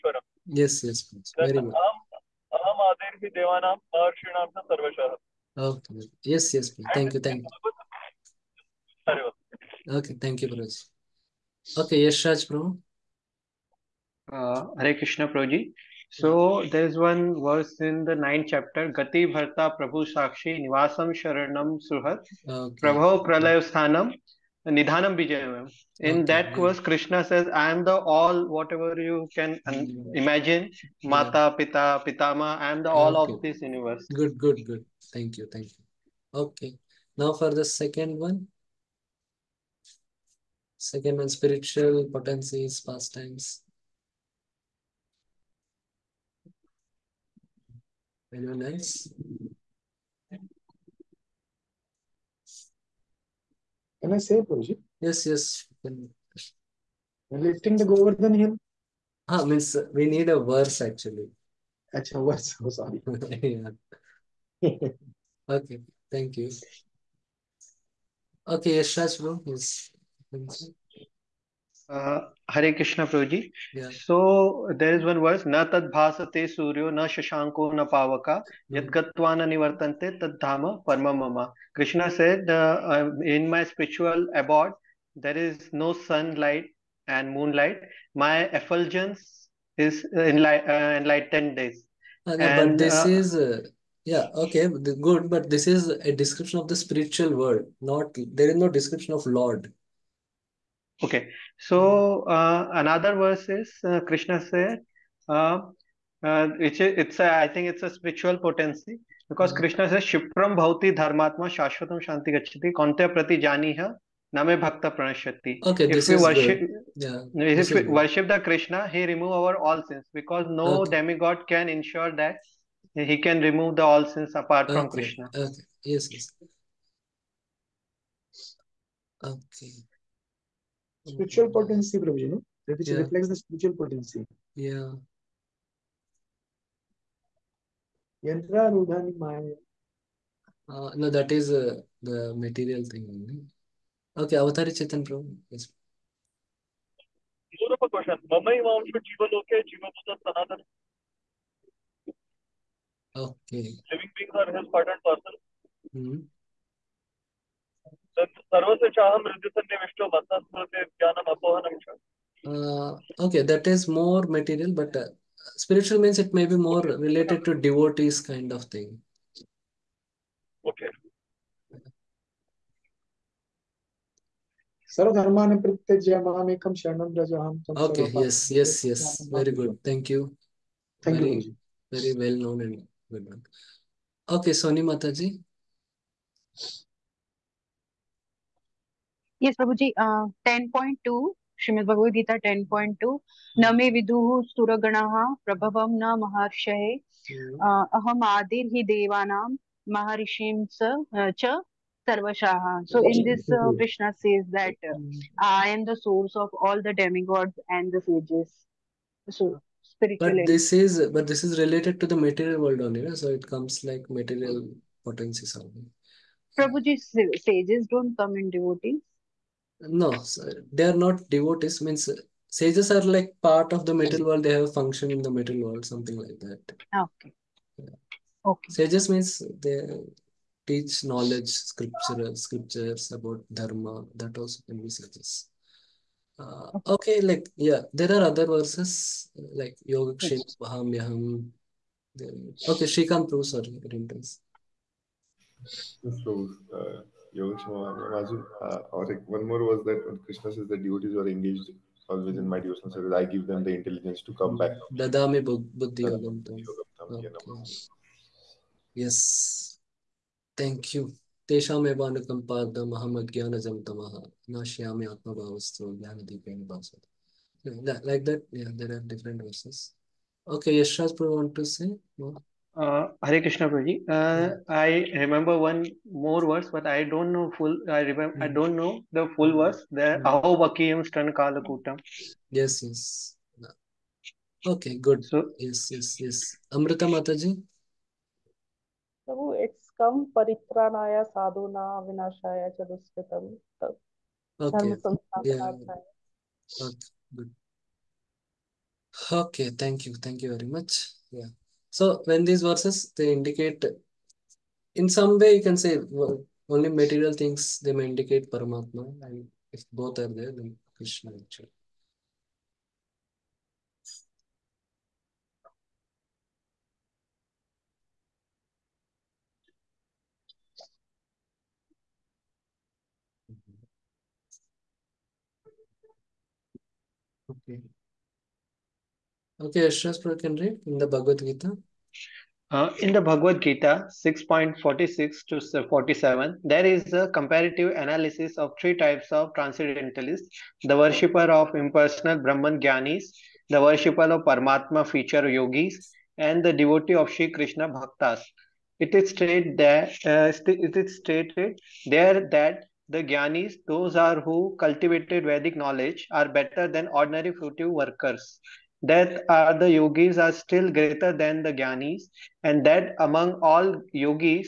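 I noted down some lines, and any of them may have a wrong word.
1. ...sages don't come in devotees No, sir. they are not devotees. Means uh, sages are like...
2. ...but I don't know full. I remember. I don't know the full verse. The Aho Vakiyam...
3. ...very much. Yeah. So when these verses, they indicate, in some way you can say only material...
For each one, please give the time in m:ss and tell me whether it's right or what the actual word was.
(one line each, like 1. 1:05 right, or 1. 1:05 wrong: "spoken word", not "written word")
1. 3:37 right
2. 4:36 right
3. 5:00 right.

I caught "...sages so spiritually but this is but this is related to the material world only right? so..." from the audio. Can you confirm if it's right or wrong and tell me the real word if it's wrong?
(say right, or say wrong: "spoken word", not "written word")
right.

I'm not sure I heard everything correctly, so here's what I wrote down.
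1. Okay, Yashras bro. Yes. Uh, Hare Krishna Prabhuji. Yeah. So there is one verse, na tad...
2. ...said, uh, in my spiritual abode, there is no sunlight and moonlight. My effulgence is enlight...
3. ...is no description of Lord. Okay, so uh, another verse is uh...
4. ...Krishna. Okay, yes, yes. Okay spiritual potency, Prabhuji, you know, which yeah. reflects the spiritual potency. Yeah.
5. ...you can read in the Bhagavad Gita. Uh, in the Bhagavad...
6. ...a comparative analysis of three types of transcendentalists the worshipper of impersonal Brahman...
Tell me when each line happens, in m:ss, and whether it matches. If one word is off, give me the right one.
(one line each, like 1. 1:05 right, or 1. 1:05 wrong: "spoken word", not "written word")
1. 1:08 right
2. 1:22 right
3. 1:38 right
4. 2:04 right
5. 5:30 right
6. 5:37 right.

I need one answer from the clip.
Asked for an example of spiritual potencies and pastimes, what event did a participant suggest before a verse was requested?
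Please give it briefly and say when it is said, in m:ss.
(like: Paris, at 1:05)
Lifting the Govardhan hill, at 0:57.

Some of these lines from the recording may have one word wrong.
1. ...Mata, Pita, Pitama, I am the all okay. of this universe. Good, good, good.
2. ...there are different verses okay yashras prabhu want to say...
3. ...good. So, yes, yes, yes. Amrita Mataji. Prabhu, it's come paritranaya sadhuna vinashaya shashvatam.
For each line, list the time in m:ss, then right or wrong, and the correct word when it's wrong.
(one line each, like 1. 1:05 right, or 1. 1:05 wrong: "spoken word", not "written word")
1. 0:31 right
2. 4:28 right
3. 4:44 wrong: "chaduskitam", not "shashvatam".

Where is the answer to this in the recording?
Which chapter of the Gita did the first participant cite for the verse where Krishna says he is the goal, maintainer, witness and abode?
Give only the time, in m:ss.
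0:18.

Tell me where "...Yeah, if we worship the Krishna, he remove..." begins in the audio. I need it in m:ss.
1:56.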